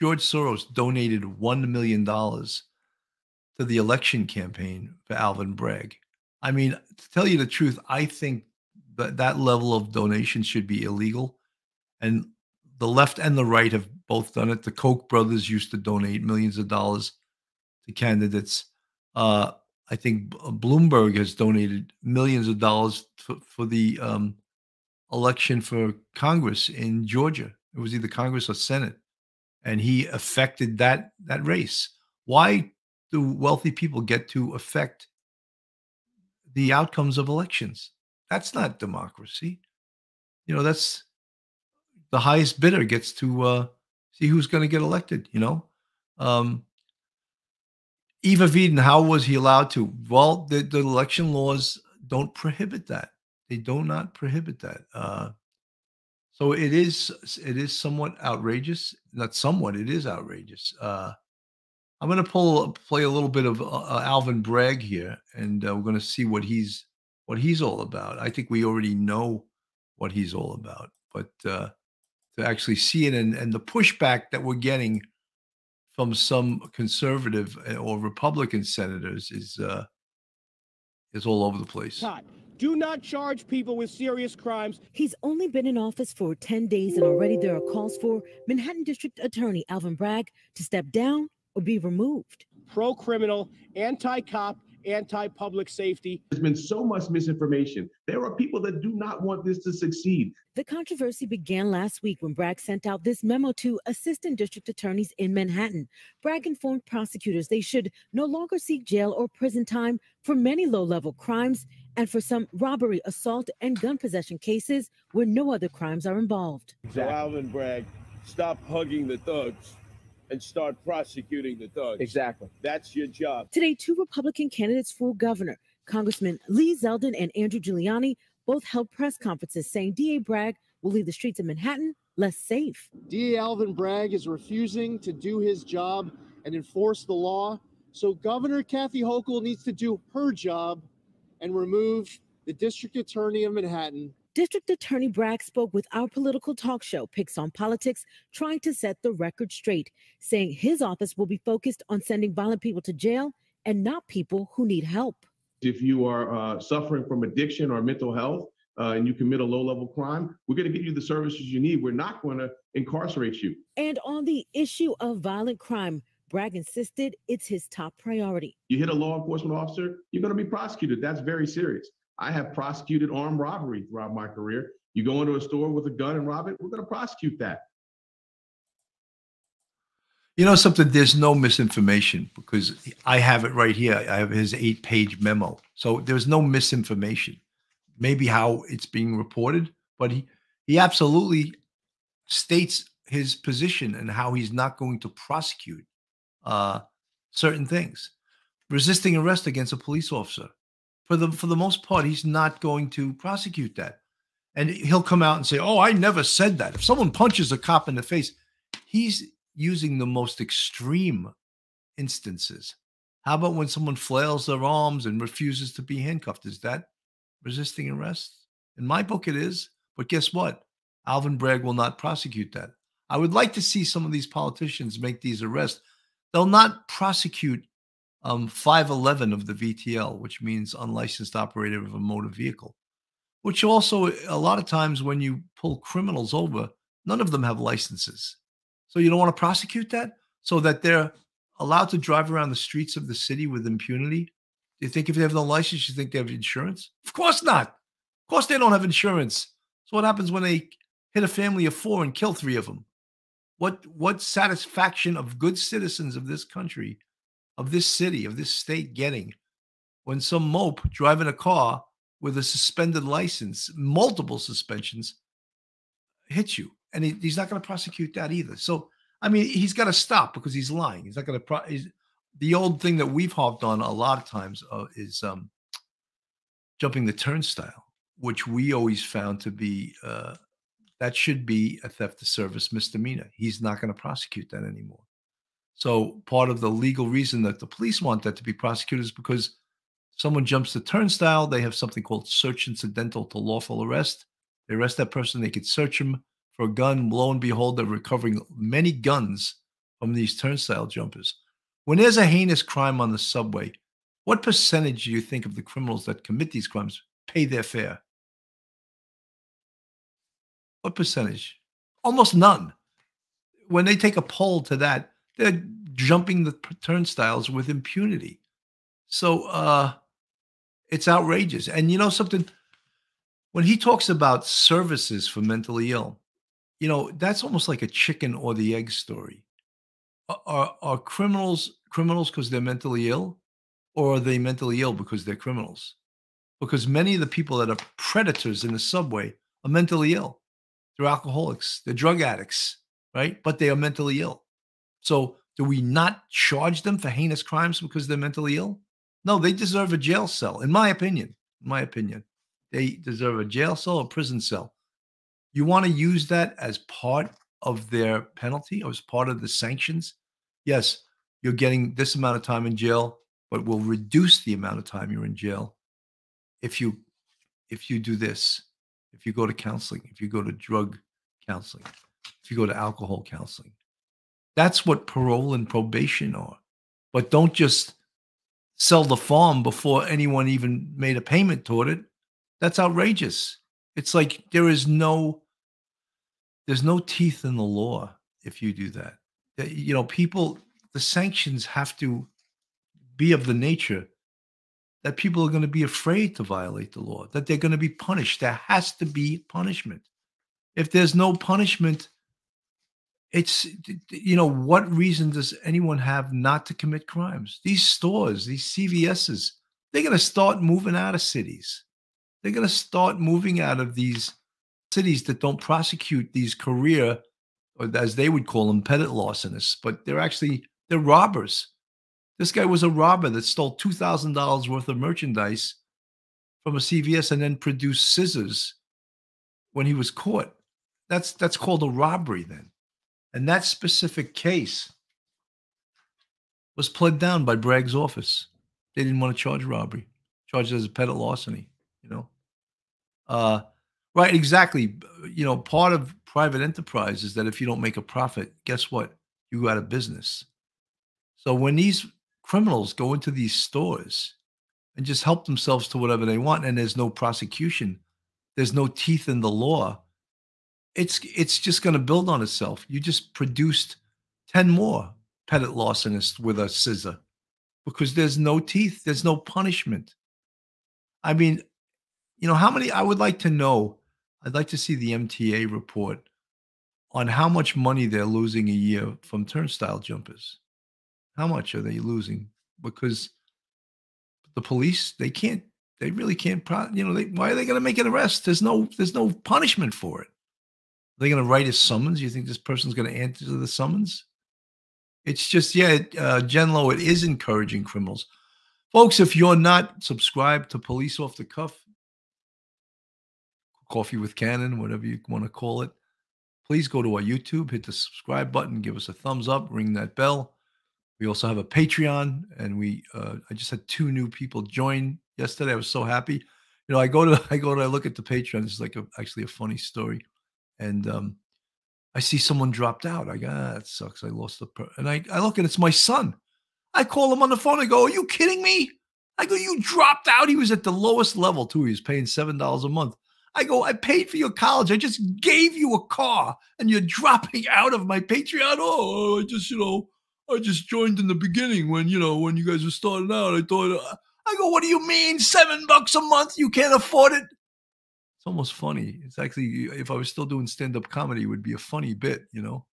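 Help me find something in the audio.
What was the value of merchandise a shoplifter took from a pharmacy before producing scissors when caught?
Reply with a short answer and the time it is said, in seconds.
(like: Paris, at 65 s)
$2,000, at 423 s.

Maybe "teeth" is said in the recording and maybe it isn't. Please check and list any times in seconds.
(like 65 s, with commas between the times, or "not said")
386 s, 458 s, 468 s.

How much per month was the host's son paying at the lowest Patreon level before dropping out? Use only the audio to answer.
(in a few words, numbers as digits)
$7.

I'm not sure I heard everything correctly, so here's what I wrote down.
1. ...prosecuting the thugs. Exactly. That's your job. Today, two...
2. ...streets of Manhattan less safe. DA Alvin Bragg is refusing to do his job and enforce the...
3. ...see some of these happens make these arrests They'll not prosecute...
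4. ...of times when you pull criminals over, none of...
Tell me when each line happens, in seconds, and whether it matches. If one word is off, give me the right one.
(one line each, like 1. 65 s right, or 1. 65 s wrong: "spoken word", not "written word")
1. 120 s right
2. 131 s right
3. 223 s wrong: "politicians", not "happens"
4. 234 s right.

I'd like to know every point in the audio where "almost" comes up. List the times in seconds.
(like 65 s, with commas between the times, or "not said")
312 s, 327 s, 548 s.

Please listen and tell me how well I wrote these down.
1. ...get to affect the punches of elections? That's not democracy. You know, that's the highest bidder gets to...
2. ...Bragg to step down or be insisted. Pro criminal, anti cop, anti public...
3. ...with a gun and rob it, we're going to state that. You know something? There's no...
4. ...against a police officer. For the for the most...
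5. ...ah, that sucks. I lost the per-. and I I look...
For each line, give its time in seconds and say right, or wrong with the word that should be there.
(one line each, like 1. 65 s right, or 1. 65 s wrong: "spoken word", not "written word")
1. 34 s wrong: "outcomes", not "punches"
2. 89 s wrong: "removed", not "insisted"
3. 175 s wrong: "prosecute", not "state"
4. 199 s right
5. 523 s right.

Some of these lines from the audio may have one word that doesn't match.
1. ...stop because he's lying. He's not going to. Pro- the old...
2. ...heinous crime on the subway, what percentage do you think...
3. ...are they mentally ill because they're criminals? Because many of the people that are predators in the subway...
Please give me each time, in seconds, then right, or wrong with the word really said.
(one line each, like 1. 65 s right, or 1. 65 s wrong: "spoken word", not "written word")
1. 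269 s right
2. 302 s right
3. 334 s right.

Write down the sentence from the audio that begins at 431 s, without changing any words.
That's that's called a robbery then.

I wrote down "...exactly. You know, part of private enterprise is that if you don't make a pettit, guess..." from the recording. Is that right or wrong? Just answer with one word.
wrong.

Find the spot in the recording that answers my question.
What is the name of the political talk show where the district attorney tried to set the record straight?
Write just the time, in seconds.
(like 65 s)
147 s.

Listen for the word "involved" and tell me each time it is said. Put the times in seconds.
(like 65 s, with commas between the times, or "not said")
116 s.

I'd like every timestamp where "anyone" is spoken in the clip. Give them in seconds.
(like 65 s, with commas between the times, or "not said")
380 s, 405 s.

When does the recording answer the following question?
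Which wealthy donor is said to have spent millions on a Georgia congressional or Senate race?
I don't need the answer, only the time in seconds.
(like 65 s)
20 s.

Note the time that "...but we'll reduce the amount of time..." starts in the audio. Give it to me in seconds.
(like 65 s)
363 s.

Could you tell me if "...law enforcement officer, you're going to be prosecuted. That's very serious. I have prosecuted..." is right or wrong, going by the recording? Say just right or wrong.
right.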